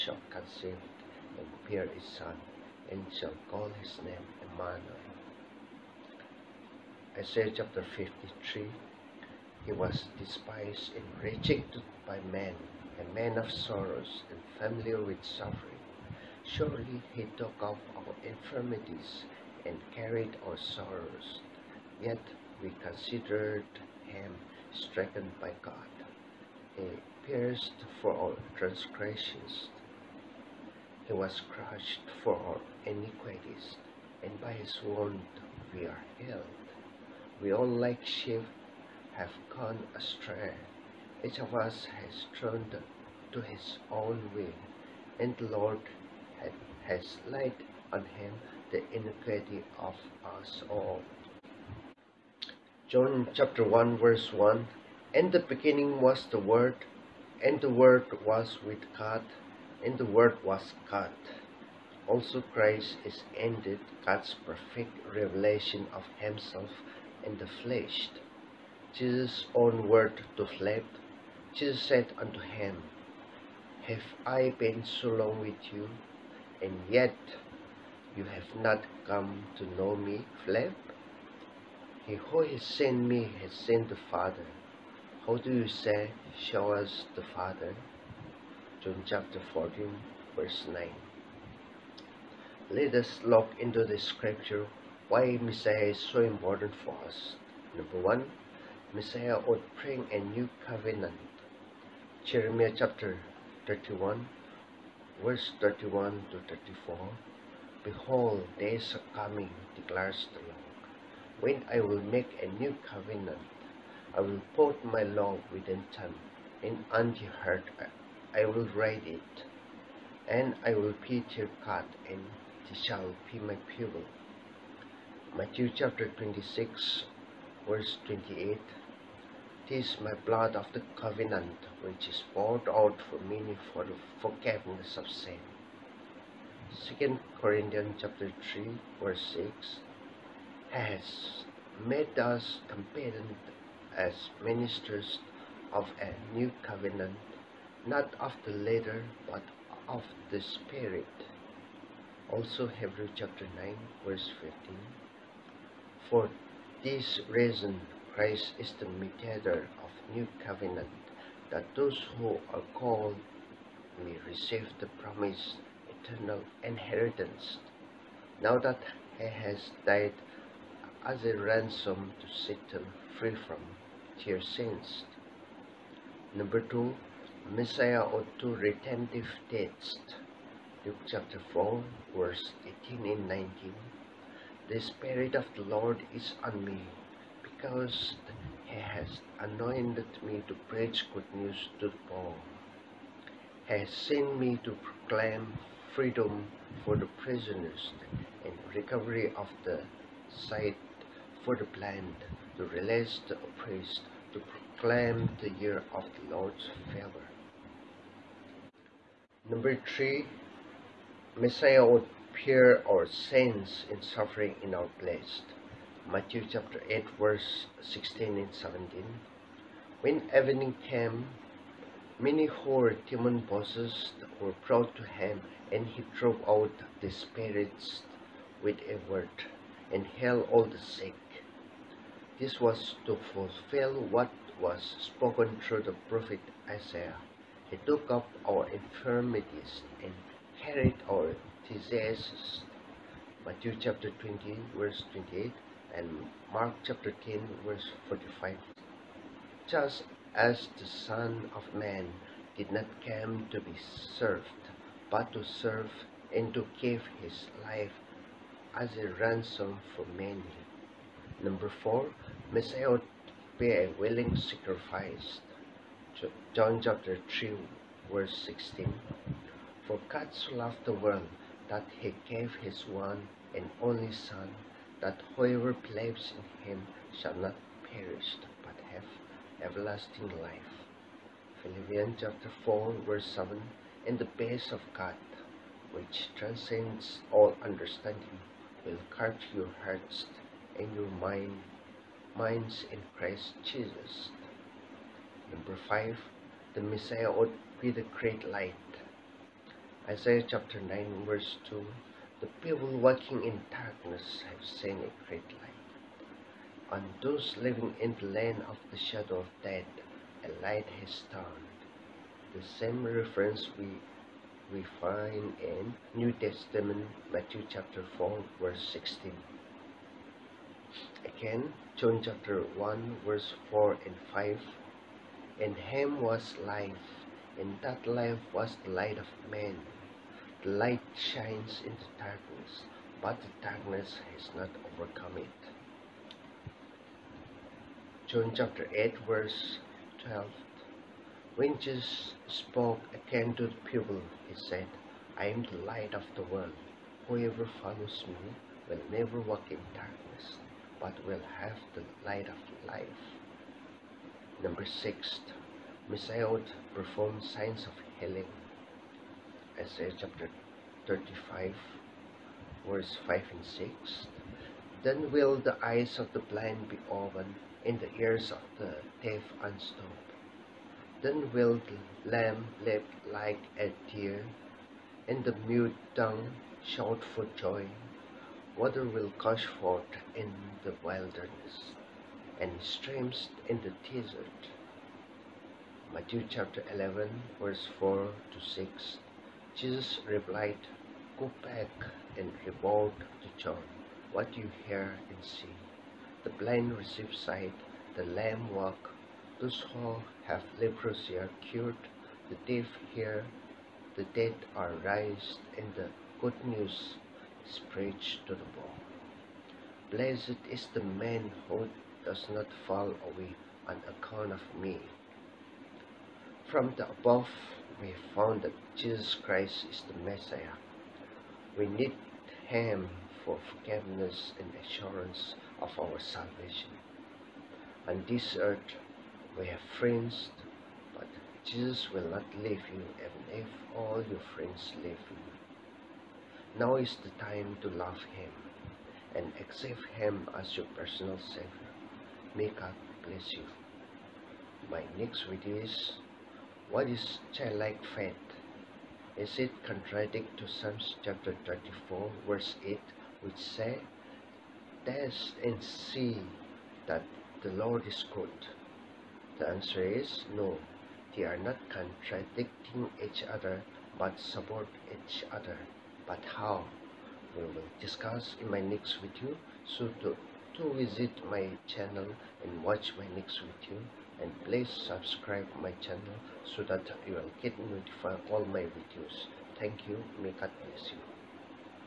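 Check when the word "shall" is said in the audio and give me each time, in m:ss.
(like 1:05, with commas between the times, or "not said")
0:03, 2:02, 4:37.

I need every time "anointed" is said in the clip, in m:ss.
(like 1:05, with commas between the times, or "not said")
3:09.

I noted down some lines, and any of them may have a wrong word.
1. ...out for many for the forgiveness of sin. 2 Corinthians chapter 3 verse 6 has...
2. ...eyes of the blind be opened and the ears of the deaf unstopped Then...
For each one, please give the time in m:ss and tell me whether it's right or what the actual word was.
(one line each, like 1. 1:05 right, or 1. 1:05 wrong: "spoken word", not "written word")
1. 2:12 right
2. 6:05 right.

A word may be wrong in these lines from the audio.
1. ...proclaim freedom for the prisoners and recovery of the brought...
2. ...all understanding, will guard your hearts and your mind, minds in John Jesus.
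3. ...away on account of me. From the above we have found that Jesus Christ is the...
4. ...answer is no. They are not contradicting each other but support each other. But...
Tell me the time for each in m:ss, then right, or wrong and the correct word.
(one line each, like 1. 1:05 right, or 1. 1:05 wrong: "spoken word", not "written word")
1. 3:14 wrong: "sight", not "brought"
2. 4:47 wrong: "Christ", not "John"
3. 6:53 right
4. 7:39 right.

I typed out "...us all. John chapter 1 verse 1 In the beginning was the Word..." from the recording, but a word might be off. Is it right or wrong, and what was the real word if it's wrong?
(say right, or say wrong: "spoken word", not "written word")
right.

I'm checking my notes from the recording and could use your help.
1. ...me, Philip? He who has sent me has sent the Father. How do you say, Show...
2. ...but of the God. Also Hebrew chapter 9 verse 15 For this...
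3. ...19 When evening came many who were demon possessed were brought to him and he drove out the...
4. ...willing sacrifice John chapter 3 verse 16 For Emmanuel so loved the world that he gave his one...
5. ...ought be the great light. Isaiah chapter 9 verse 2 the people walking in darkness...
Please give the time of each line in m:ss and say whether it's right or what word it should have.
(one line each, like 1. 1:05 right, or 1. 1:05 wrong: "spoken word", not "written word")
1. 1:19 right
2. 2:29 wrong: "Spirit", not "God"
3. 3:38 wrong: "17", not "19"
4. 4:23 wrong: "God", not "Emmanuel"
5. 4:57 right.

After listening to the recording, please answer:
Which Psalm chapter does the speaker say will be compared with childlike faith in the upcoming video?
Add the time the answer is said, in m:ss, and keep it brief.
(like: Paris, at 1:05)
Psalm 34, at 7:30.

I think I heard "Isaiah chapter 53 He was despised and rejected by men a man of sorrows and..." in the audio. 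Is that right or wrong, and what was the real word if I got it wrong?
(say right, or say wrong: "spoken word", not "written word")
right.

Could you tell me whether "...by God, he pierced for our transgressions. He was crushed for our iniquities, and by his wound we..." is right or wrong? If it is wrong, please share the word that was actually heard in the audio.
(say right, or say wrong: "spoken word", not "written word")
right.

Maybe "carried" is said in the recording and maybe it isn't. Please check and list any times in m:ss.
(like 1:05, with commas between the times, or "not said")
0:19, 4:00.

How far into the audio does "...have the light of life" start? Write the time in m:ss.
5:51.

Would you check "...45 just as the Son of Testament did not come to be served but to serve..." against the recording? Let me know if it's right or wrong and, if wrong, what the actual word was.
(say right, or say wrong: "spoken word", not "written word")
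wrong: "Man", not "Testament".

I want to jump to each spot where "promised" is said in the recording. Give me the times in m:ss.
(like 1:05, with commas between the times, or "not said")
2:45.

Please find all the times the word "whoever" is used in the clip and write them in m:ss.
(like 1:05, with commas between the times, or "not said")
4:35, 5:47.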